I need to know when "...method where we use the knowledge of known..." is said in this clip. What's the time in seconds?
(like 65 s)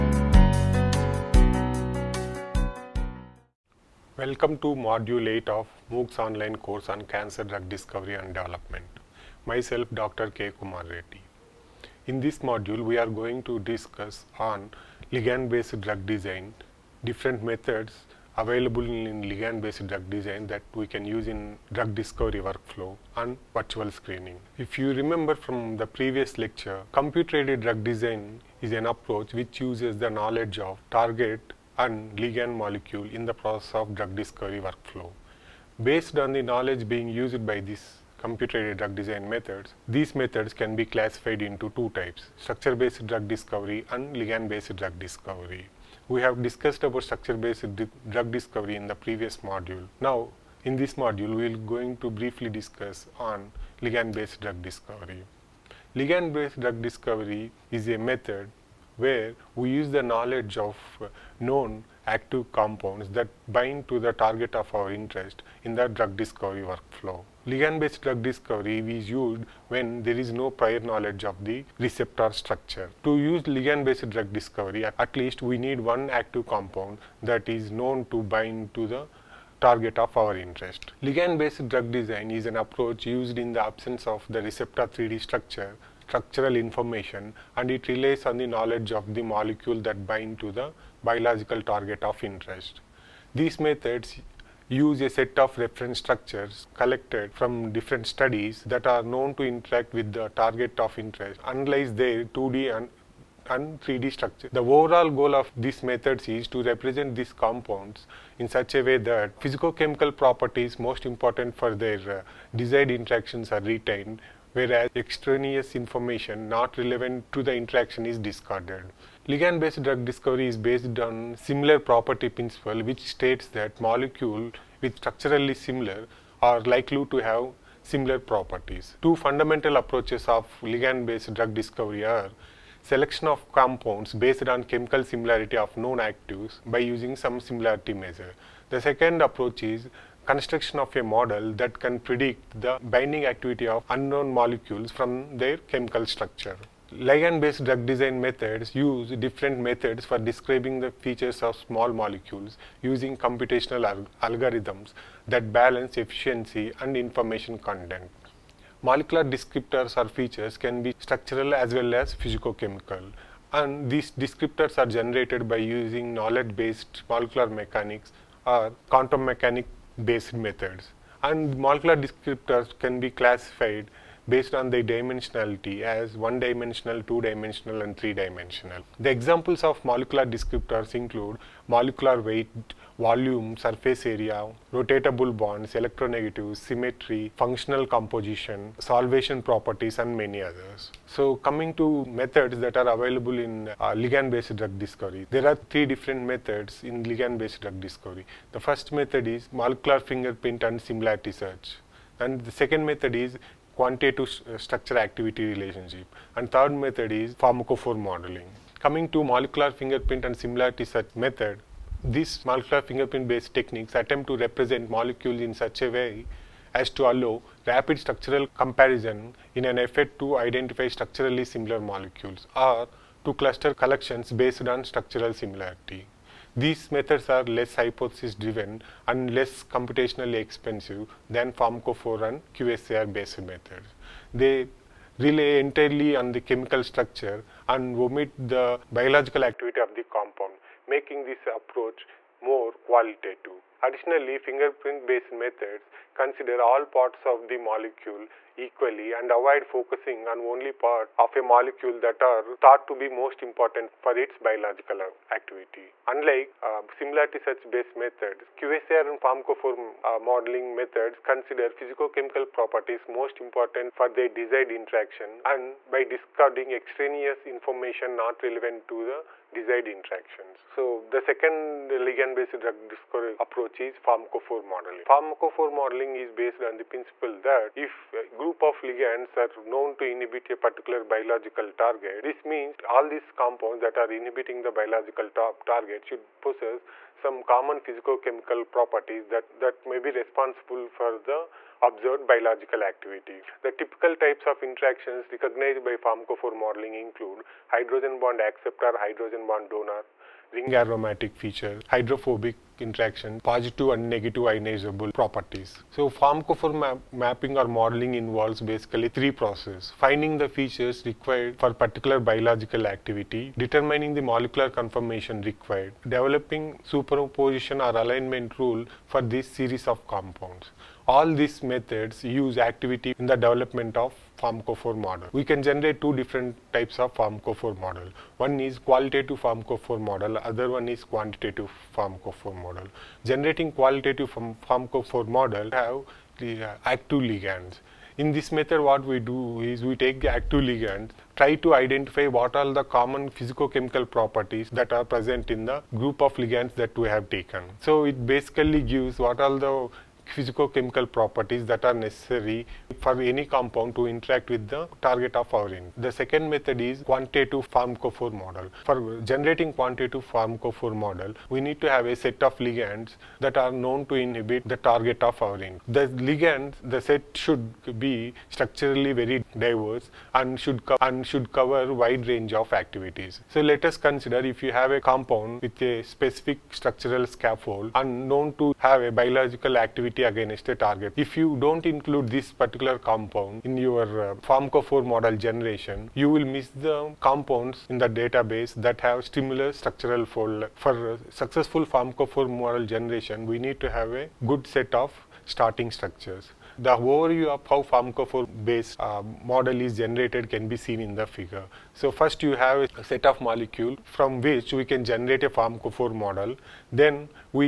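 57 s.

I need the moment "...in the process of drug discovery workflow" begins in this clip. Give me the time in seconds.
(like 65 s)
33 s.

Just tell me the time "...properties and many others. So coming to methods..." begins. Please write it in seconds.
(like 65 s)
189 s.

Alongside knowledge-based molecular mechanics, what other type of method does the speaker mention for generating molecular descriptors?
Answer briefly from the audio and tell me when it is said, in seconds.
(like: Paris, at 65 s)
quantum mechanics, at 168 s.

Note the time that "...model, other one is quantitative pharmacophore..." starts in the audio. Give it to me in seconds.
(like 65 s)
330 s.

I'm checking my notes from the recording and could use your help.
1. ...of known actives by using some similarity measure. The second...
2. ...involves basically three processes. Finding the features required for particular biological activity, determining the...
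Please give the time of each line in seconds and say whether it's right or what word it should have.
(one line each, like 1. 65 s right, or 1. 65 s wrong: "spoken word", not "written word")
1. 135 s right
2. 308 s right.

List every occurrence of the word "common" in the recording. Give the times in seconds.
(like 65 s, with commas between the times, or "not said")
287 s, 342 s.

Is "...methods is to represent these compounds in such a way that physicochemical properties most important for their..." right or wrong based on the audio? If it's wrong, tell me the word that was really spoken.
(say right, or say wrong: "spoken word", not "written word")
right.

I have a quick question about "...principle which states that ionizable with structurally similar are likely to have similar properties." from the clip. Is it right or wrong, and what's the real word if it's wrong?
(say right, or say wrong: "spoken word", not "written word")
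wrong: "molecule", not "ionizable".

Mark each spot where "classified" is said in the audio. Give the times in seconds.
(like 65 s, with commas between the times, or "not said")
40 s, 173 s.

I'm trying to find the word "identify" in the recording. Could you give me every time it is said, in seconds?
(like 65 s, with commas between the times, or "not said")
220 s, 341 s.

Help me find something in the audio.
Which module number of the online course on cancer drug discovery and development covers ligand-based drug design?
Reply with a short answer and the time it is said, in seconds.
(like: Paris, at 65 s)
8, at 4 s.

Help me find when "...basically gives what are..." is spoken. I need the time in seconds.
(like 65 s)
348 s.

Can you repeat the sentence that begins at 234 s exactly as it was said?
They rely entirely on the chemical structure and omit the biological activity of the compound, making this approach more qualitative.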